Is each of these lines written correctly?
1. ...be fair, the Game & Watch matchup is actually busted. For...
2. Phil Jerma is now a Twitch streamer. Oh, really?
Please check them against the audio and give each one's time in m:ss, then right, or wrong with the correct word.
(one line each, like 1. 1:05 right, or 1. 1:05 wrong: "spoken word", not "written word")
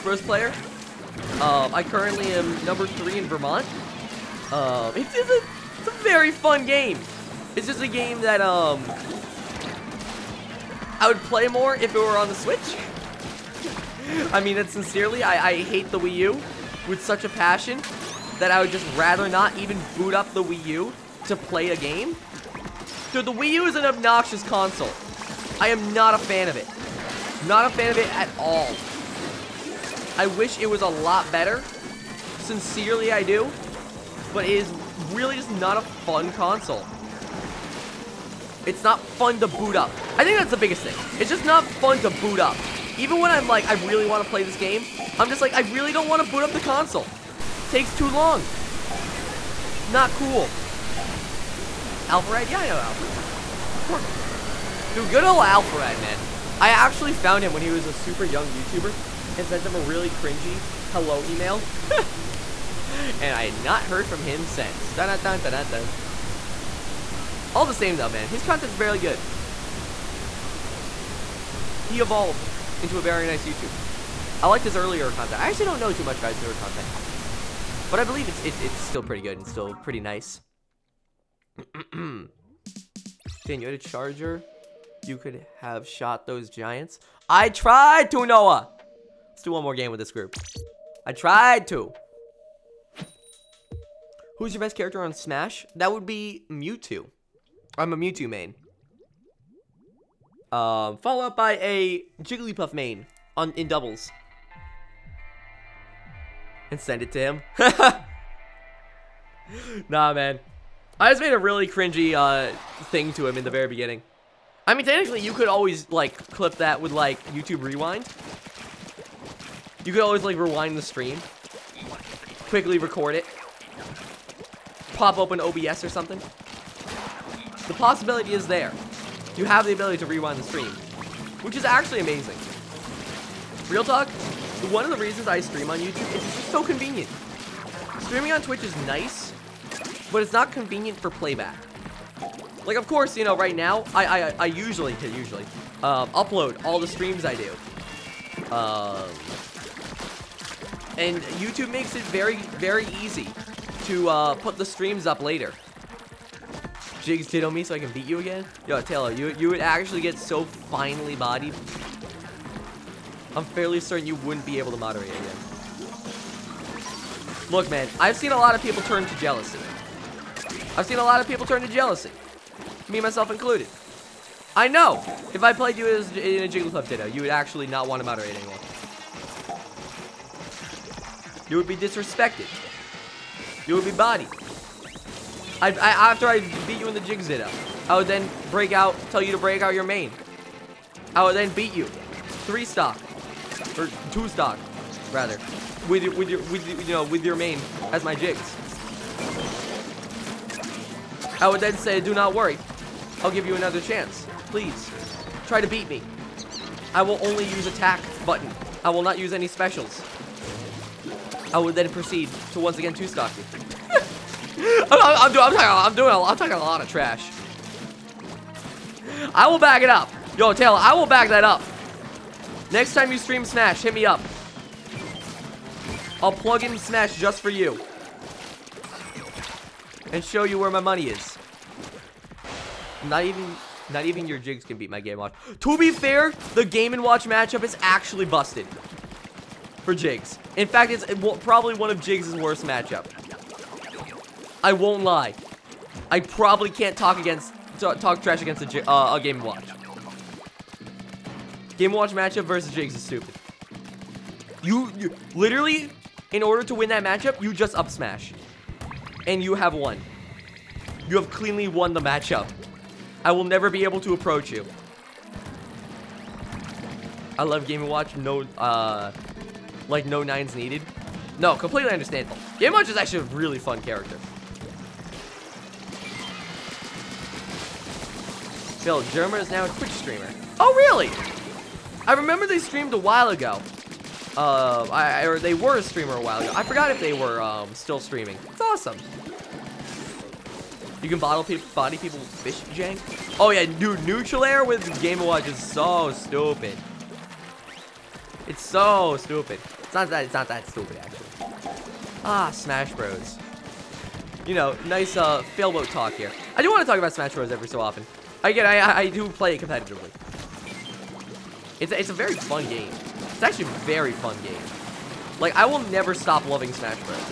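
1. 3:55 right
2. 4:38 right.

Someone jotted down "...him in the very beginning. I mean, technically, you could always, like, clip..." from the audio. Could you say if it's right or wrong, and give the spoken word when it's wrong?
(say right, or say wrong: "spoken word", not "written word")
right.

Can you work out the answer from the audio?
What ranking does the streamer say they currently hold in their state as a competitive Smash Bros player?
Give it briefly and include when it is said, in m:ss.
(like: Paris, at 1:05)
3, at 0:02.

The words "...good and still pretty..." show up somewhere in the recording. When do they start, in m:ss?
1:19.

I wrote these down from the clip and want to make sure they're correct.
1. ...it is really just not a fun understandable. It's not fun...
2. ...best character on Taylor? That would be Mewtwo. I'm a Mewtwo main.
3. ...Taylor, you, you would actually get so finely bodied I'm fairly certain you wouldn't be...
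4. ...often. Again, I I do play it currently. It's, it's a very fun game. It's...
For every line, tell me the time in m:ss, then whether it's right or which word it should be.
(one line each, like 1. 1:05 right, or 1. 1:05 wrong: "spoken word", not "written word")
1. 0:34 wrong: "console", not "understandable"
2. 1:34 wrong: "Smash", not "Taylor"
3. 2:38 right
4. 5:07 wrong: "competitively", not "currently".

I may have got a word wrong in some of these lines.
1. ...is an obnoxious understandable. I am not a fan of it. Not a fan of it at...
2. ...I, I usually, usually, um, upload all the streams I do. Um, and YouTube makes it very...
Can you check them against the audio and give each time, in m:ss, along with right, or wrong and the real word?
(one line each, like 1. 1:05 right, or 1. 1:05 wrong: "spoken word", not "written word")
1. 0:23 wrong: "console", not "understandable"
2. 2:24 right.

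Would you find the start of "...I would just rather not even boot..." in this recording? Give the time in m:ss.
0:18.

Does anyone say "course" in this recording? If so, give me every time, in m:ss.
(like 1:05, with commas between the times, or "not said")
0:53, 2:22.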